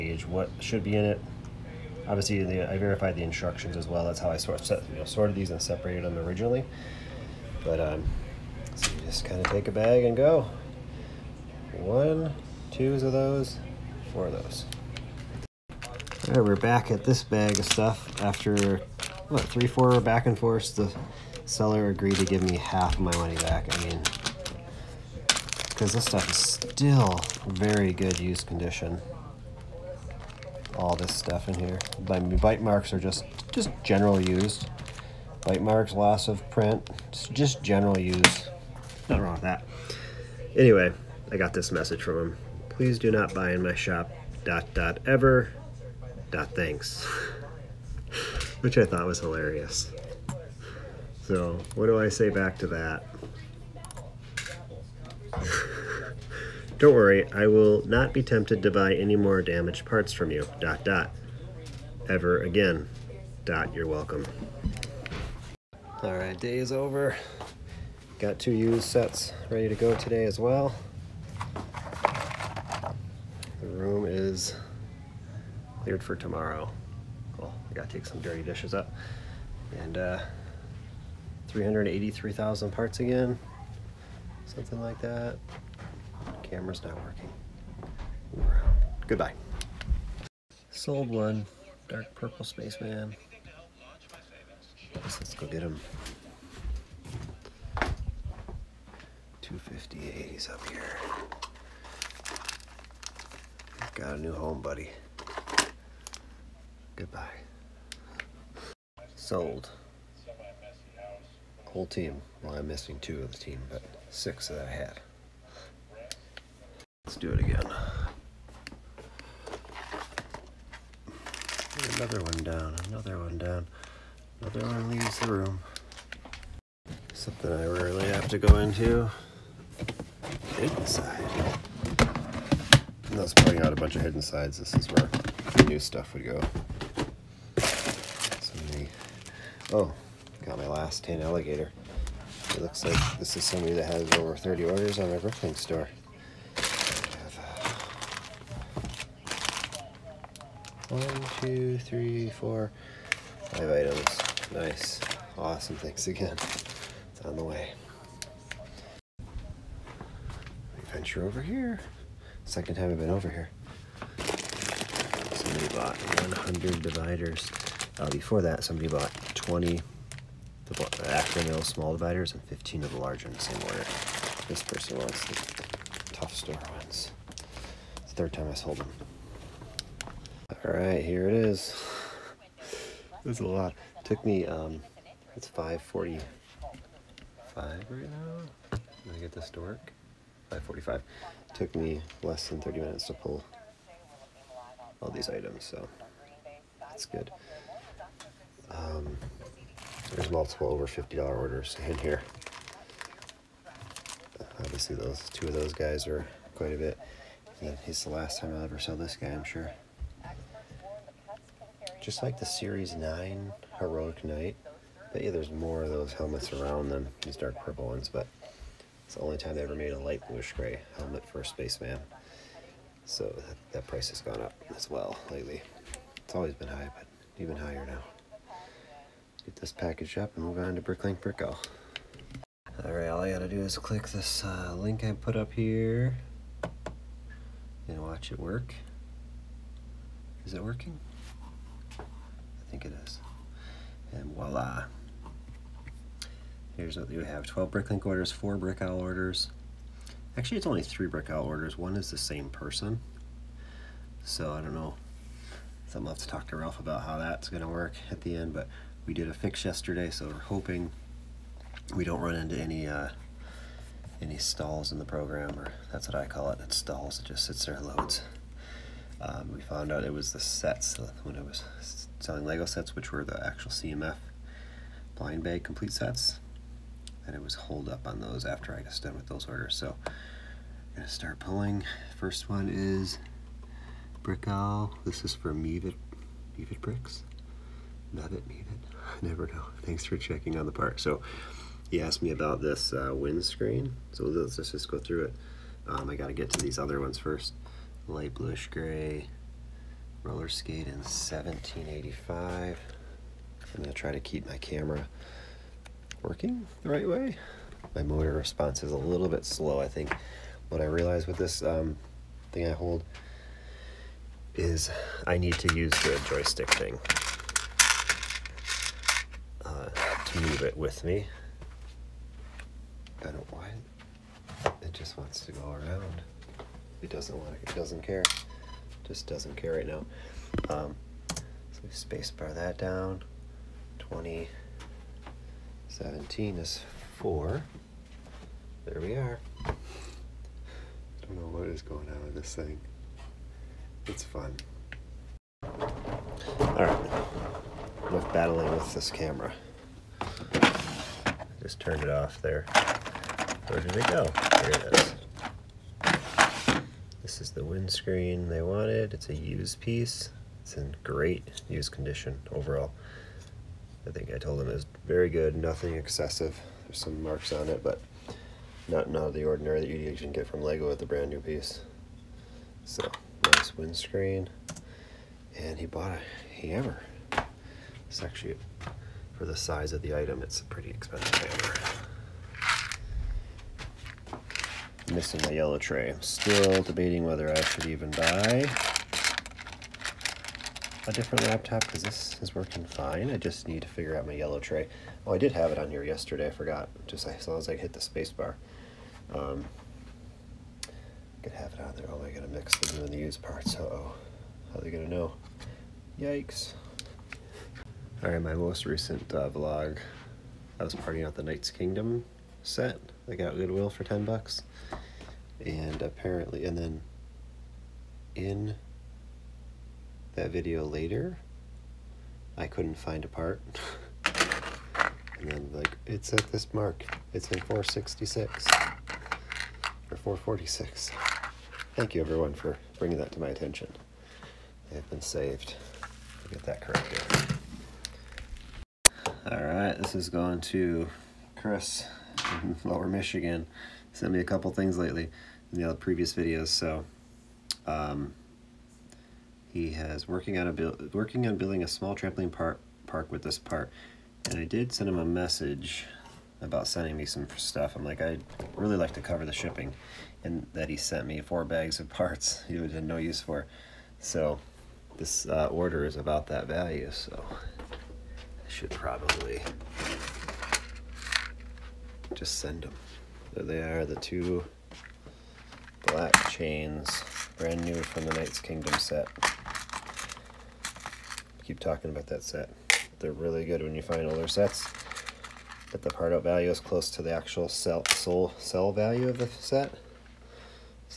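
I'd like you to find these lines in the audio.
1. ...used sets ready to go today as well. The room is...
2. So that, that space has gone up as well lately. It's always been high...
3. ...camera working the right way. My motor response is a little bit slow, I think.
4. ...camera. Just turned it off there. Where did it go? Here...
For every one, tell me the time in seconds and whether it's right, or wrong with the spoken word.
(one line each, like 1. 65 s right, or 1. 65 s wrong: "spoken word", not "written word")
1. 68 s right
2. 223 s wrong: "price", not "space"
3. 304 s right
4. 349 s right.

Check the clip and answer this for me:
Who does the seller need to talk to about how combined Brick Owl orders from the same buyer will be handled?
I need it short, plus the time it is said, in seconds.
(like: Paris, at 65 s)
Ralph, at 256 s.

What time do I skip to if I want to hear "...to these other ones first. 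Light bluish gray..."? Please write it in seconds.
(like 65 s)
296 s.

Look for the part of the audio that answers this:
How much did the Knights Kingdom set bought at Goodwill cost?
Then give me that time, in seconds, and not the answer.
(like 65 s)
414 s.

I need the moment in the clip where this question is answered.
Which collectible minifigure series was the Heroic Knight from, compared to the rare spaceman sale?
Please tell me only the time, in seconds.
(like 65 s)
212 s.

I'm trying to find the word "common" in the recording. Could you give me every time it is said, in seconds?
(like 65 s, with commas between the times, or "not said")
not said.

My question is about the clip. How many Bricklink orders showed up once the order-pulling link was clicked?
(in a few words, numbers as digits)
12.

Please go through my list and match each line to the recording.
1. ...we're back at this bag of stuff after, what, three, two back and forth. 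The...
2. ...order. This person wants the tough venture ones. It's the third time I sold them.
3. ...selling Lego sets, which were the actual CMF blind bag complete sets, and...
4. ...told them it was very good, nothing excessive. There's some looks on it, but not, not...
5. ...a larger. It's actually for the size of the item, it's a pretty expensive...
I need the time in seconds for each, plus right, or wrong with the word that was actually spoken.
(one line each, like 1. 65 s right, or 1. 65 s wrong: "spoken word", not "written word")
1. 16 s wrong: "four", not "two"
2. 173 s wrong: "store", not "venture"
3. 272 s right
4. 364 s wrong: "marks", not "looks"
5. 376 s wrong: "hammer", not "larger".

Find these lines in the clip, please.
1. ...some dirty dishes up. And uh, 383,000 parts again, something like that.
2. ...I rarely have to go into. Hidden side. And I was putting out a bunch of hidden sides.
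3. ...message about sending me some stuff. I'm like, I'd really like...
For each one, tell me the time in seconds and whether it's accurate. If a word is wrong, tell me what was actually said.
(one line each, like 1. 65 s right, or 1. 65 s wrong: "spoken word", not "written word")
1. 78 s right
2. 127 s right
3. 455 s right.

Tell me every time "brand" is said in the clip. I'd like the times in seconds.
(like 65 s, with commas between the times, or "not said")
371 s, 477 s.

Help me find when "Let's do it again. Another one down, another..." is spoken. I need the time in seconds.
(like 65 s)
117 s.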